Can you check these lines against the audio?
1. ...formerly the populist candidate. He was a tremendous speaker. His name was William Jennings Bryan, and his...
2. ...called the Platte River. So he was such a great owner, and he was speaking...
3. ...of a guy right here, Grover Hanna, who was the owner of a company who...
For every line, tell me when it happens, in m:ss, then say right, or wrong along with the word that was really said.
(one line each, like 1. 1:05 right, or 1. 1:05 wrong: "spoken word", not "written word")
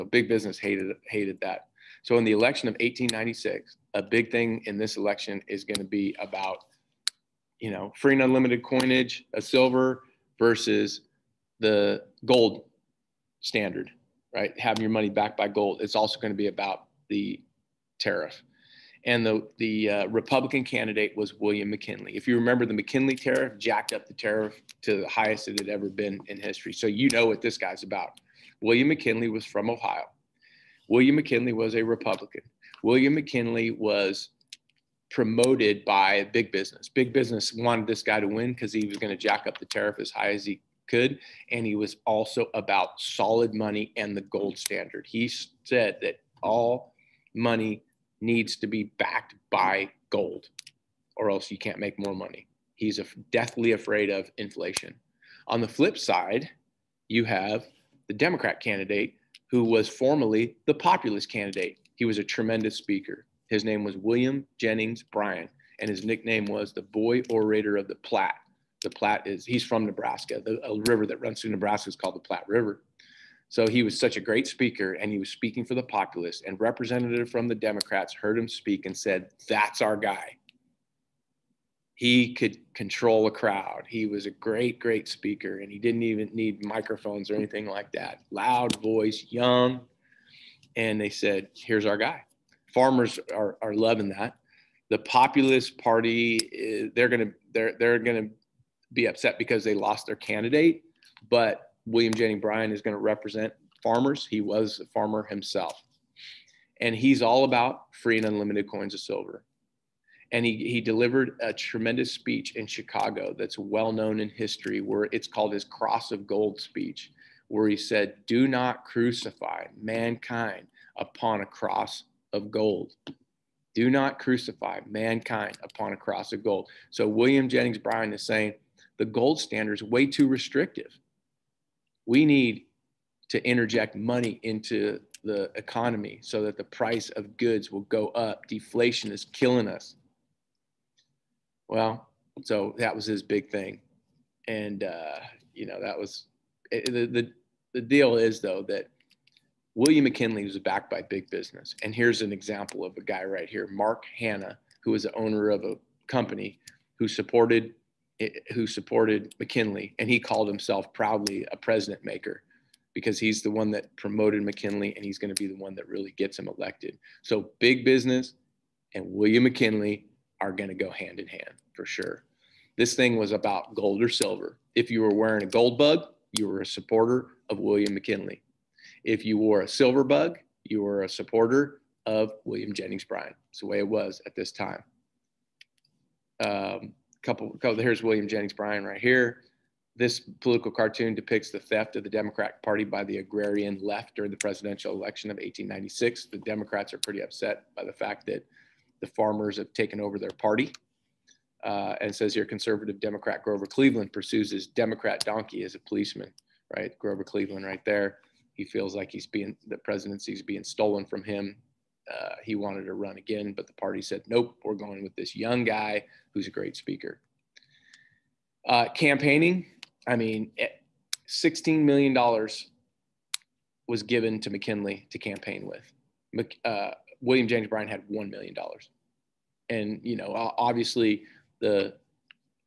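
1. 0:59 right
2. 1:11 wrong: "speaker", not "owner"
3. 2:32 wrong: "Mark", not "Grover".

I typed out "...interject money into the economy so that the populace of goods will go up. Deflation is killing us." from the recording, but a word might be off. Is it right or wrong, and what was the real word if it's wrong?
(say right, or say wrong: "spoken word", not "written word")
wrong: "price", not "populace".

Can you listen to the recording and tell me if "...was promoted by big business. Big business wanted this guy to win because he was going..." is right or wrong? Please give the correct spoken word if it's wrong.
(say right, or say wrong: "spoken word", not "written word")
right.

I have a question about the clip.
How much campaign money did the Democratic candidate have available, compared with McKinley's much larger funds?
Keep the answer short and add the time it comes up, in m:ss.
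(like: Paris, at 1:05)
$1 million, at 3:48.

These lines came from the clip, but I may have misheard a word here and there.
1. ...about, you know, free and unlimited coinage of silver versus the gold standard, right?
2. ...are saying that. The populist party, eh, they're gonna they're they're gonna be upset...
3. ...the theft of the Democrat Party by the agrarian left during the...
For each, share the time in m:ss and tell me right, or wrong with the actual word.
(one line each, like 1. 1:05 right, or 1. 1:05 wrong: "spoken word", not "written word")
1. 0:06 right
2. 1:33 wrong: "loving", not "saying"
3. 3:11 right.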